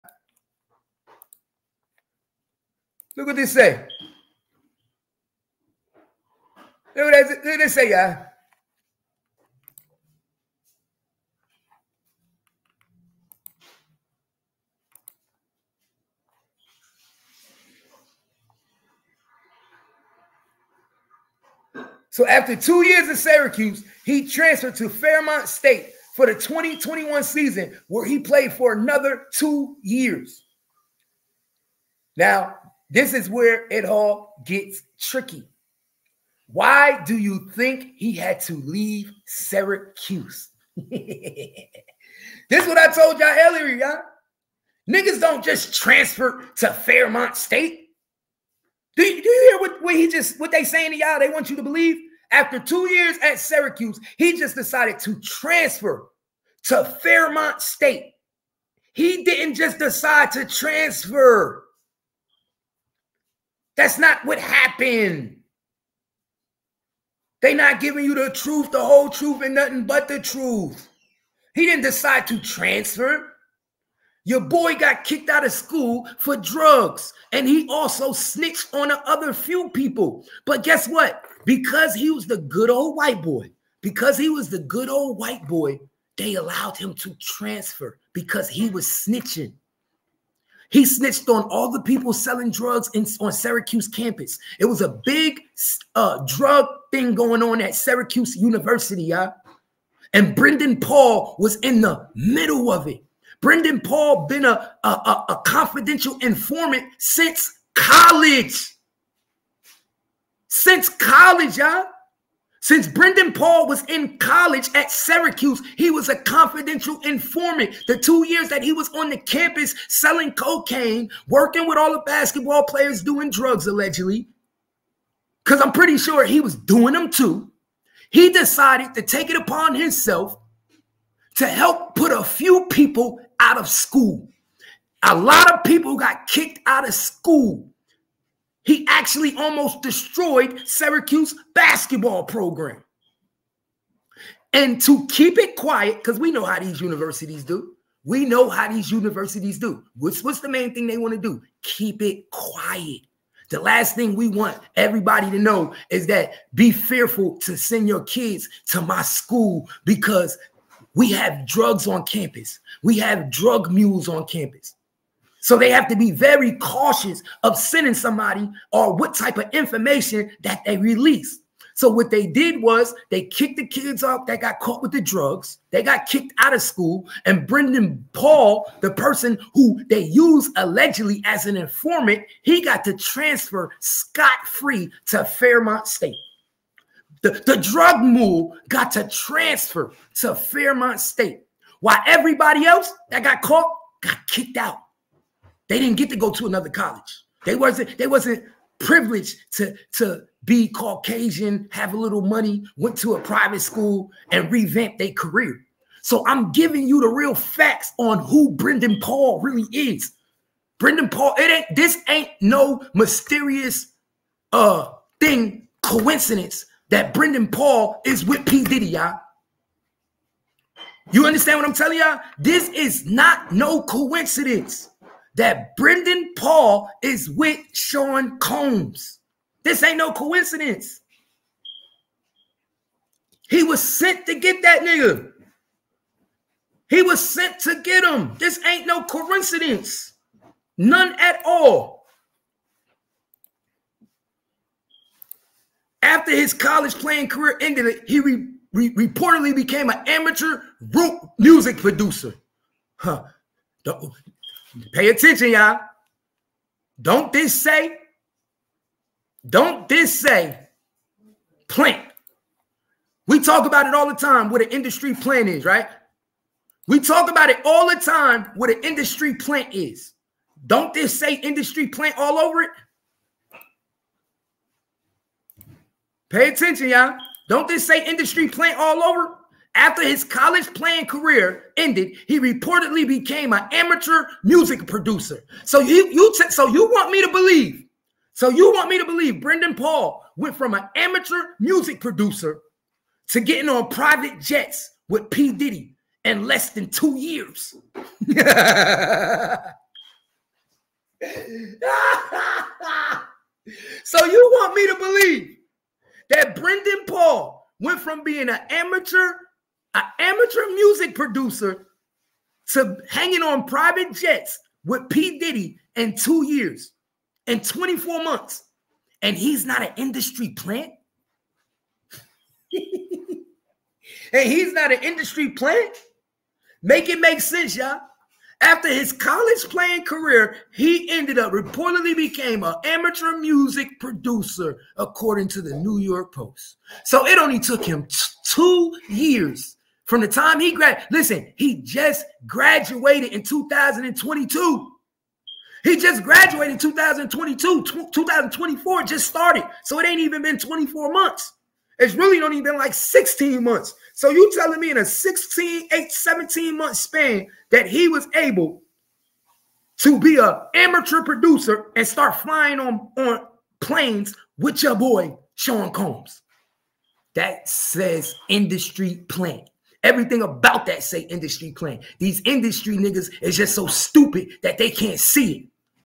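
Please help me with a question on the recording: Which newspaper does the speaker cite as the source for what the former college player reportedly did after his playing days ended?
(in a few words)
New York Post.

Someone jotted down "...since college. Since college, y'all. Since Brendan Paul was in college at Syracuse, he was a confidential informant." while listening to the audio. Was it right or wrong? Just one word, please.
right.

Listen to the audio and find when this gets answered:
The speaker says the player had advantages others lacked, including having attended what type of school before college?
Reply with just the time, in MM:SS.
03:23.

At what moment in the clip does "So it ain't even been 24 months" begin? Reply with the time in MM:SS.
05:49.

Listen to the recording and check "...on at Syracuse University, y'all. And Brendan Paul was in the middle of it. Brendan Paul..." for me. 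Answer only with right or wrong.
right.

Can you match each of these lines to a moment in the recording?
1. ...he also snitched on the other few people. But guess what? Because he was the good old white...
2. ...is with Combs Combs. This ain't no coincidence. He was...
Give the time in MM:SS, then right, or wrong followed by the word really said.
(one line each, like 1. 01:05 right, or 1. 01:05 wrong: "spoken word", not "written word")
1. 01:17 right
2. 03:47 wrong: "Sean", not "Combs".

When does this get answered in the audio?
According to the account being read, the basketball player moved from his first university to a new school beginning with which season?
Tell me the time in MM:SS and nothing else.
00:26.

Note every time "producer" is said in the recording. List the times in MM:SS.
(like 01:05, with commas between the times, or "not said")
04:11, 04:44, 04:52, 05:11, 05:33, 06:01.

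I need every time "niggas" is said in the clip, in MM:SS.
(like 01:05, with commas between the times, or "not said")
00:44, 03:54, 06:12.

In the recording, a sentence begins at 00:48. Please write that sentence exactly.
Do you, do you hear what, what he just what they saying to y'all?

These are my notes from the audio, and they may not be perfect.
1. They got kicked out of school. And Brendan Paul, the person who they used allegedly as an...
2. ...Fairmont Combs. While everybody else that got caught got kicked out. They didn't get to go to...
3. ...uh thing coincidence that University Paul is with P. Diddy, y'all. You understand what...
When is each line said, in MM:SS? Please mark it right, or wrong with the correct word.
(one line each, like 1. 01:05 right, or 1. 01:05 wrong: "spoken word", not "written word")
1. 02:55 right
2. 03:10 wrong: "State", not "Combs"
3. 03:34 wrong: "Brendan", not "University".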